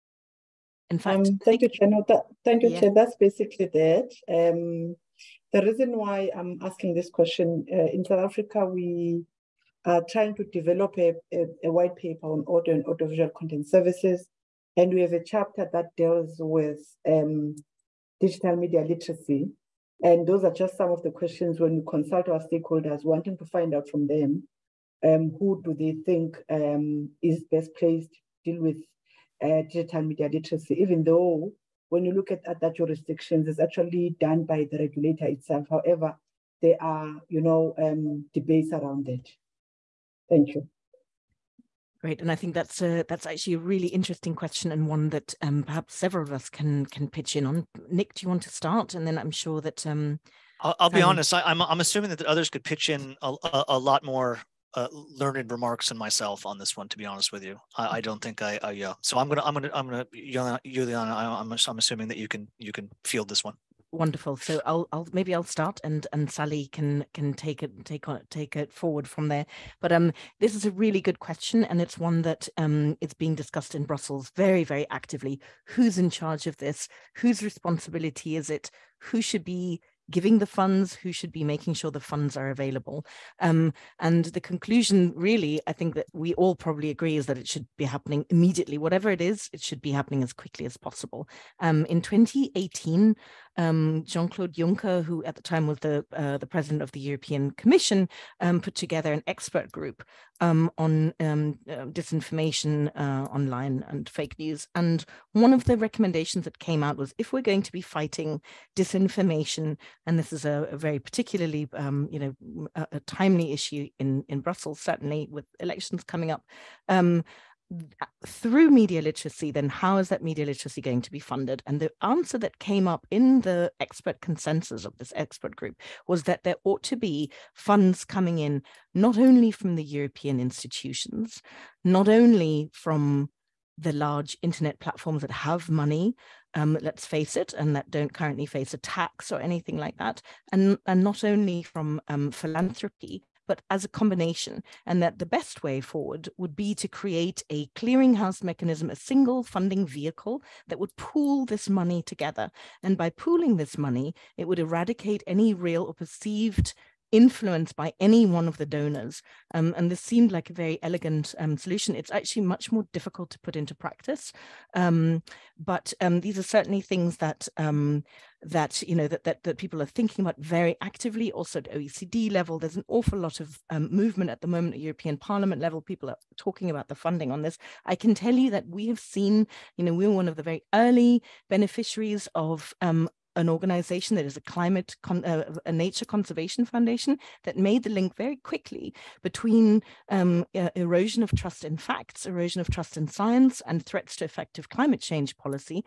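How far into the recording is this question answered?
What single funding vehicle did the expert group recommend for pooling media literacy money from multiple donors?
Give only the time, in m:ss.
2:27.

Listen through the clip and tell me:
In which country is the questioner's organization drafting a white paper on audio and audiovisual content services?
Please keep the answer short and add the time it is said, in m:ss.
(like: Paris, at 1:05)
South Africa, at 0:08.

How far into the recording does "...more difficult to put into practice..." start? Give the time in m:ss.
2:42.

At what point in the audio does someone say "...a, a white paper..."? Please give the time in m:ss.
0:11.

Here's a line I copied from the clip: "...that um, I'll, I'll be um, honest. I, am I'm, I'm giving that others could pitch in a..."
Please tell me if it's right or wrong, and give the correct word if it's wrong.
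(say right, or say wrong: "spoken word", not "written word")
wrong: "assuming", not "giving".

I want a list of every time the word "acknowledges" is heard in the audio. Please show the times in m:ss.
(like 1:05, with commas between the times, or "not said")
not said.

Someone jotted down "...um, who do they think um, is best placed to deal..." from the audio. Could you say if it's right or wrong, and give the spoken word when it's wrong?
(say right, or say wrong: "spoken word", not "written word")
right.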